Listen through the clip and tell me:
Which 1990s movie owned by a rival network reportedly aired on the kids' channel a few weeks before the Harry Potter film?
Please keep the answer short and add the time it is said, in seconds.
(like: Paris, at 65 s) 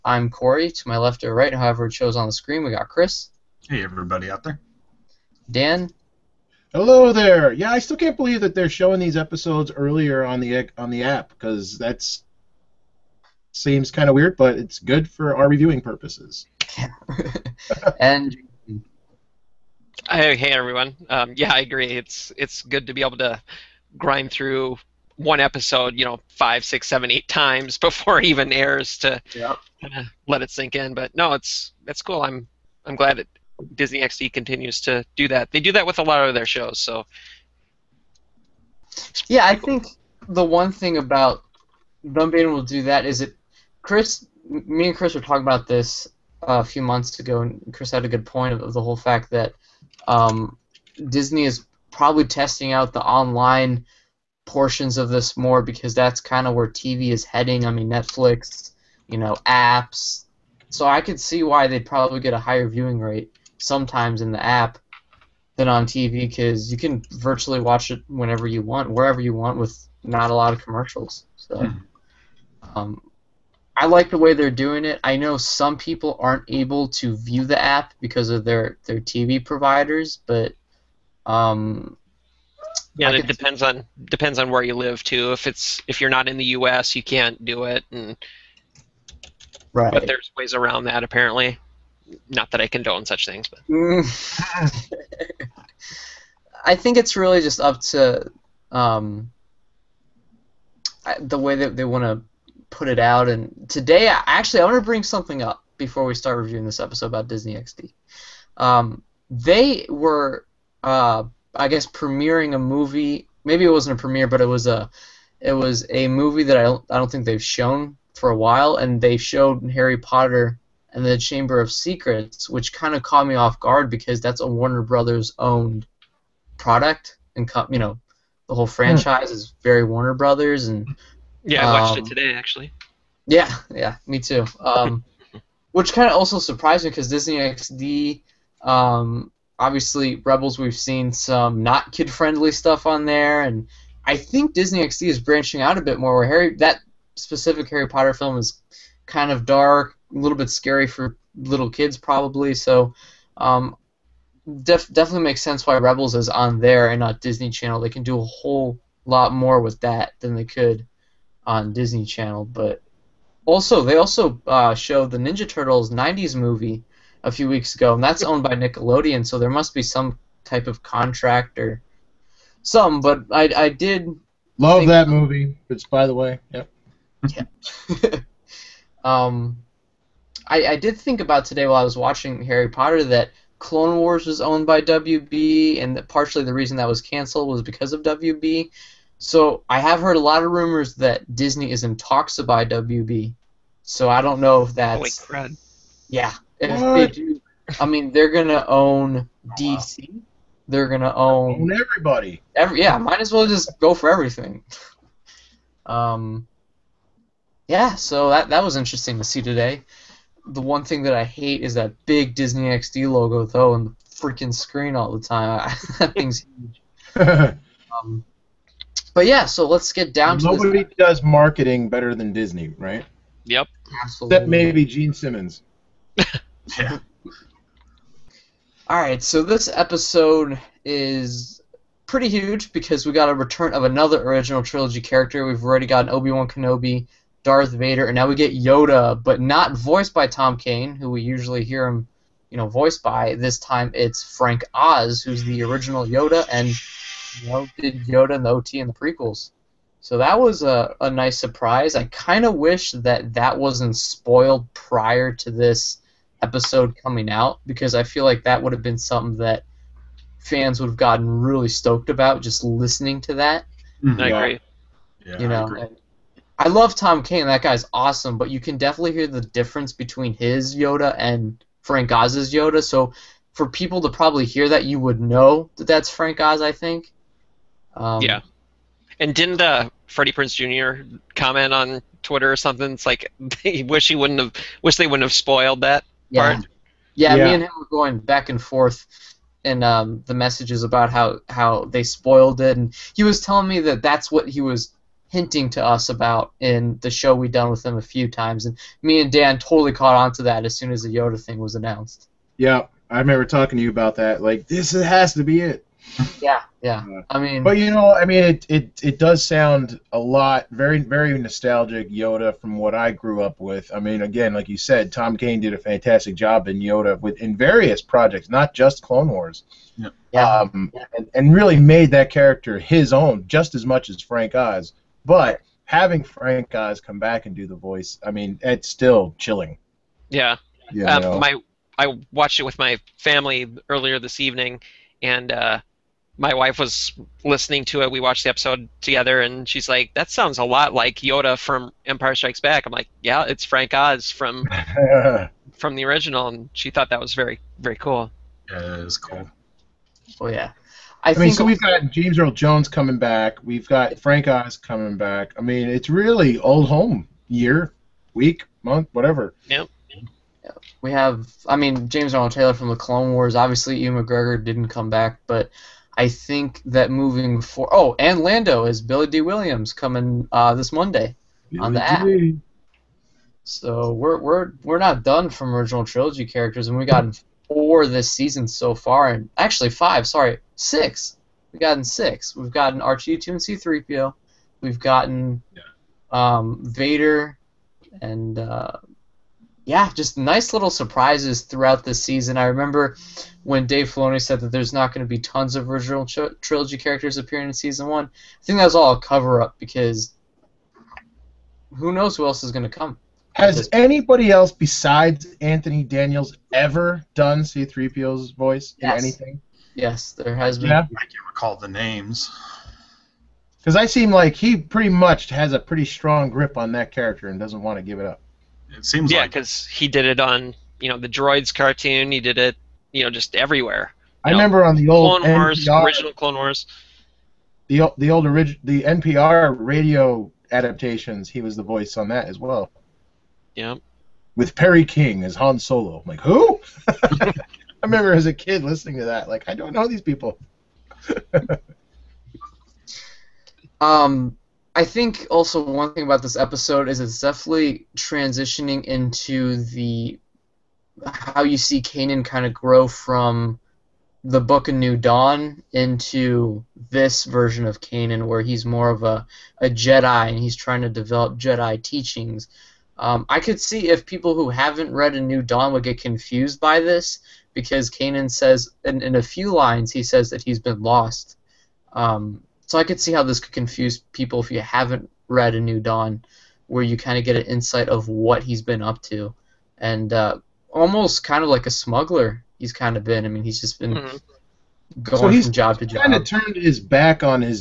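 Ninja Turtles, at 165 s.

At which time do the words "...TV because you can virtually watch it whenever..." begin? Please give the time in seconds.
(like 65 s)
65 s.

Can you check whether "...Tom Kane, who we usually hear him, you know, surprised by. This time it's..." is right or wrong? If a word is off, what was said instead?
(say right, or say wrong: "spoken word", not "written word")
wrong: "voiced", not "surprised".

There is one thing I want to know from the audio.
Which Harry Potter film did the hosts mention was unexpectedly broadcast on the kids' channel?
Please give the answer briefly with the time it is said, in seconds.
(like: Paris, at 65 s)
Chamber of Secrets, at 121 s.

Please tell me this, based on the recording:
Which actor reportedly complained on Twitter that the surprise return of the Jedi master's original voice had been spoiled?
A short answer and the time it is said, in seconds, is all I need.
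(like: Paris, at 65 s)
Freddie Prinze Jr., at 280 s.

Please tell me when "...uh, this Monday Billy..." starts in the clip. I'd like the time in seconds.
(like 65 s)
370 s.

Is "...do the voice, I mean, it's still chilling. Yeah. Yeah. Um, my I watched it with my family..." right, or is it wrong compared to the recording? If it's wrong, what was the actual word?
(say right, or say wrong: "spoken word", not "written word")
right.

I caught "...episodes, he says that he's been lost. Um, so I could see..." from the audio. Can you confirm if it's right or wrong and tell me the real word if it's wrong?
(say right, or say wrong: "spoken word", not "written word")
wrong: "lines", not "episodes".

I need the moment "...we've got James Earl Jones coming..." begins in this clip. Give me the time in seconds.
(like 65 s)
351 s.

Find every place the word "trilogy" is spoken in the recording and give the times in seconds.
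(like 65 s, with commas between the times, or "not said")
234 s, 376 s, 396 s.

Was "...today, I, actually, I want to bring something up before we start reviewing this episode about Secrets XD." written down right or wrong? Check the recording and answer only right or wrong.
wrong.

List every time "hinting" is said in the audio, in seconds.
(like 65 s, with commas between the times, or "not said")
295 s.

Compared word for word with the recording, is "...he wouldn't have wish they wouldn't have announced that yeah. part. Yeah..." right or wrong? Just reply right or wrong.
wrong.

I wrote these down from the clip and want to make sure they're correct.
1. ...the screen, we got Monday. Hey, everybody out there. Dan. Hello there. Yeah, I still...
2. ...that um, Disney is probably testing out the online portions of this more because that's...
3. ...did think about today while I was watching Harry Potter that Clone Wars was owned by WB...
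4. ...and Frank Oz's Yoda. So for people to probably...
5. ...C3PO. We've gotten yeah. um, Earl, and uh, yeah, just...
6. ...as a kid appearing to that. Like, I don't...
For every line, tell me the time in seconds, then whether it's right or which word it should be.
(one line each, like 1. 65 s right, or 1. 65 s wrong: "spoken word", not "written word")
1. 2 s wrong: "Chris", not "Monday"
2. 49 s right
3. 180 s right
4. 271 s right
5. 383 s wrong: "Vader", not "Earl"
6. 438 s wrong: "listening", not "appearing".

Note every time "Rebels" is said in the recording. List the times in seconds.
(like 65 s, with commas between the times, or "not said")
140 s, 155 s.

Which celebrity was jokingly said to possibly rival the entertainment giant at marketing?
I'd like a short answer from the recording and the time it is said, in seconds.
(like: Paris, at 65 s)
Gene Simmons, at 224 s.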